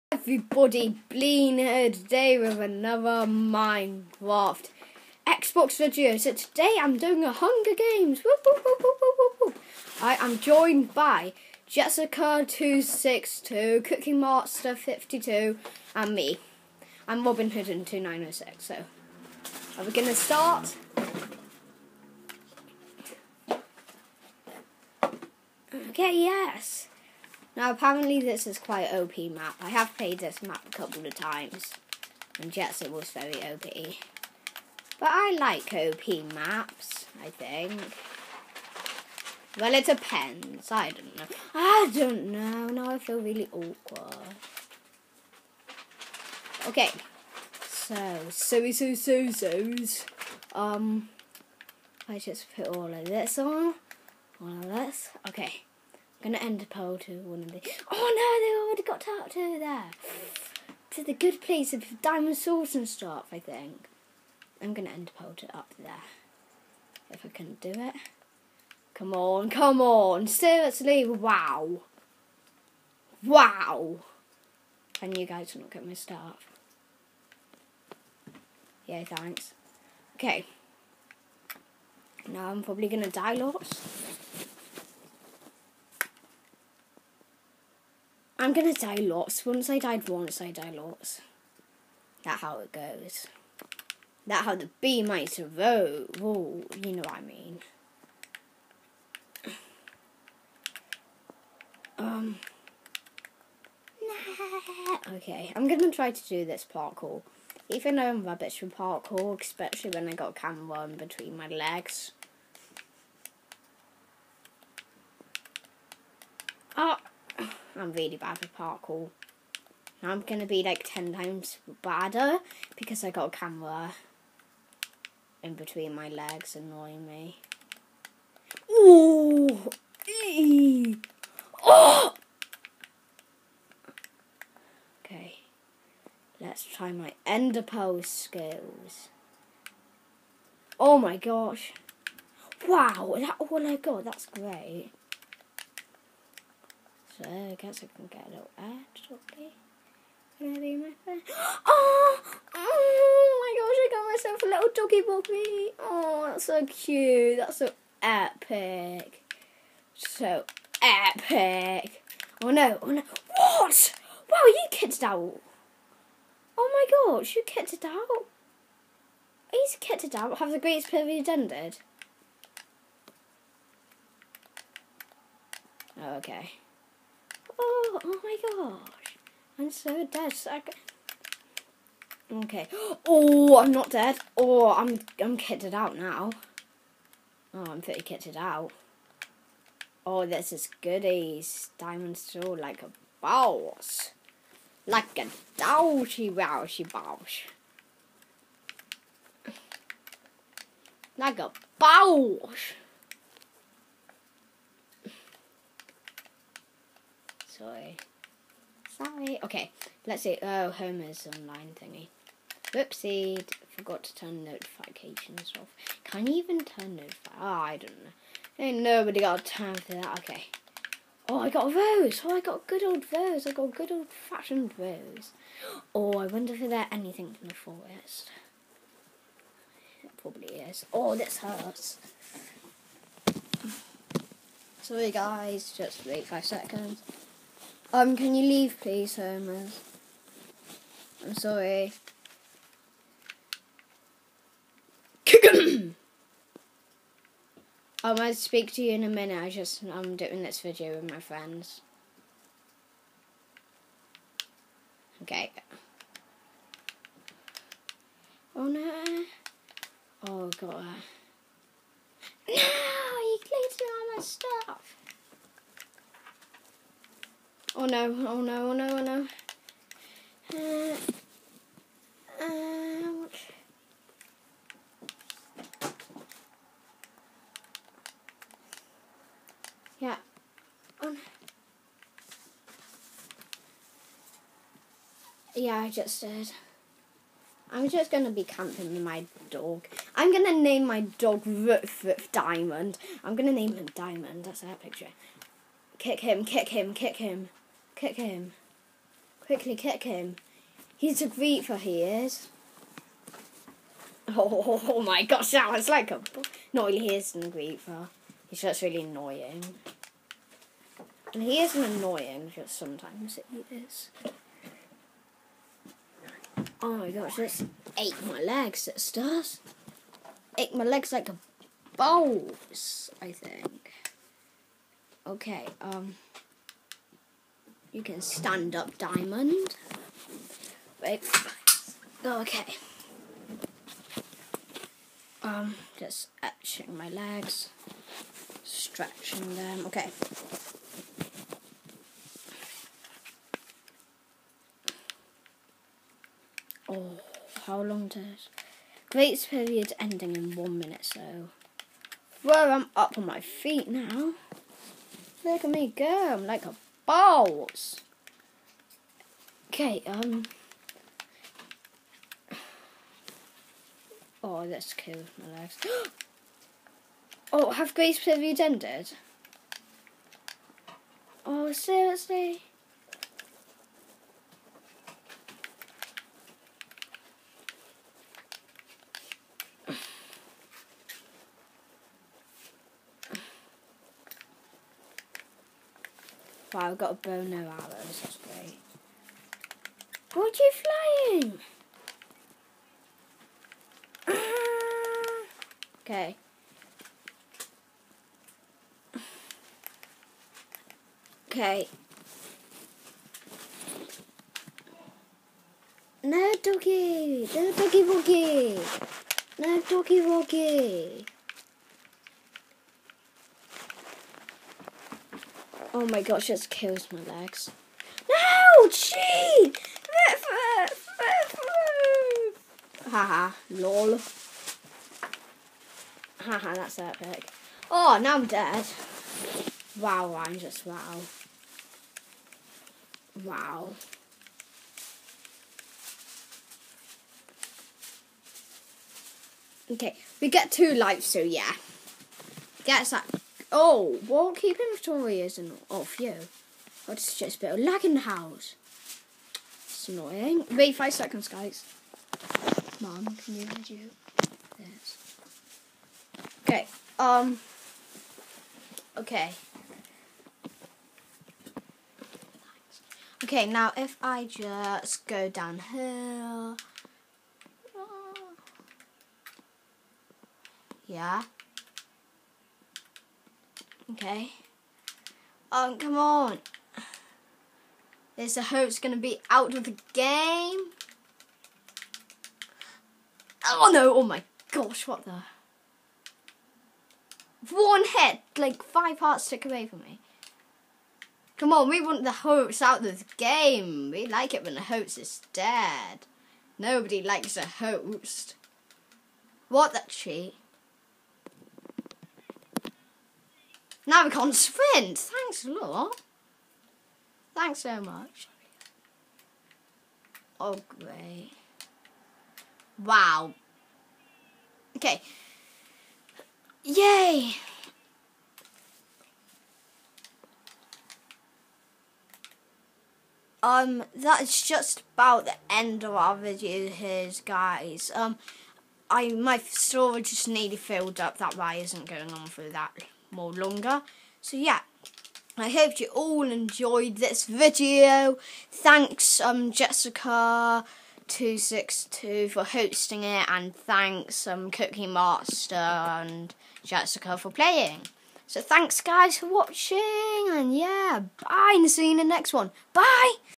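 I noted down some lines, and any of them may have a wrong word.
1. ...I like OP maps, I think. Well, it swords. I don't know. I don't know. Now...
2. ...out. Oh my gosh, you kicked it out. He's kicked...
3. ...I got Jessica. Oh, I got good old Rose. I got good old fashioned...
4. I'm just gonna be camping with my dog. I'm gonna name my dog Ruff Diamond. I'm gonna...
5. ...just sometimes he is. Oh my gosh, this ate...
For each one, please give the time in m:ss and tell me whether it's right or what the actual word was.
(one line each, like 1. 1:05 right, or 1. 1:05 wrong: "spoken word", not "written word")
1. 0:35 wrong: "depends", not "swords"
2. 2:45 right
3. 3:41 wrong: "Rose", not "Jessica"
4. 4:47 right
5. 5:12 right.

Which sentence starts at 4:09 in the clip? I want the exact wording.
I just I'm doing this video with my friends.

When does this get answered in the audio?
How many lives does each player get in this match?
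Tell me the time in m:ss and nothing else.
7:20.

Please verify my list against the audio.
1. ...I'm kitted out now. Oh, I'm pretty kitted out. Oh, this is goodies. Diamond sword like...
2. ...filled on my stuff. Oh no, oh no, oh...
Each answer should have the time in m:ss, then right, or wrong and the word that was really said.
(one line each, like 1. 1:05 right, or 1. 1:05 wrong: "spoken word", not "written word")
1. 3:05 right
2. 4:23 wrong: "clicked", not "filled".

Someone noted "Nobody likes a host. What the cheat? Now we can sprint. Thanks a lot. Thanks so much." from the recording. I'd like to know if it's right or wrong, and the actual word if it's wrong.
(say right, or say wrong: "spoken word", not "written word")
right.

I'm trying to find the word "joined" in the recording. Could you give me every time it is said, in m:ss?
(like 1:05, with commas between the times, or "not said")
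0:10.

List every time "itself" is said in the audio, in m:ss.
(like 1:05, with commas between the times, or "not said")
not said.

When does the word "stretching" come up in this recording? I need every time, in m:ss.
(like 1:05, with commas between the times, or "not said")
5:38.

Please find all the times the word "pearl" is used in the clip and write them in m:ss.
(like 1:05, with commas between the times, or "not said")
0:56, 1:05.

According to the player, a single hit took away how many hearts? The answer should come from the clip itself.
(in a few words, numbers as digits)
5.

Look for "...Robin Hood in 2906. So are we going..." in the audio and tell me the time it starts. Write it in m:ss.
0:17.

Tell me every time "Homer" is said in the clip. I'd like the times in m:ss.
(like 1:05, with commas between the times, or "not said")
3:30, 3:59.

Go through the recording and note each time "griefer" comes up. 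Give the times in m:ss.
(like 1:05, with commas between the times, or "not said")
5:01, 5:07.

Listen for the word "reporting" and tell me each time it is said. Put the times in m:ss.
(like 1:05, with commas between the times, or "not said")
not said.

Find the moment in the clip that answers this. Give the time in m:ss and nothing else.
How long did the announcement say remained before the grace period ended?
5:50.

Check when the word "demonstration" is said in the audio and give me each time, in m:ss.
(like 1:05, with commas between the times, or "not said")
not said.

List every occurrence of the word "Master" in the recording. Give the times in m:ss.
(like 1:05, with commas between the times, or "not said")
0:14, 9:05.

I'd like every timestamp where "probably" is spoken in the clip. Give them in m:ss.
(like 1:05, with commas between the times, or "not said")
1:22, 3:50.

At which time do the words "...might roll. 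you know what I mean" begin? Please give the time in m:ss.
1:35.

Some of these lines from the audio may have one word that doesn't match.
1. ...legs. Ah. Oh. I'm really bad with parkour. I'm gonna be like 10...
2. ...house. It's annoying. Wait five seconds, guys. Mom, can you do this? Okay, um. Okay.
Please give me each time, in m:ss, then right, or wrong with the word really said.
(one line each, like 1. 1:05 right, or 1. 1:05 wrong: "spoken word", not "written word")
1. 1:51 right
2. 7:28 right.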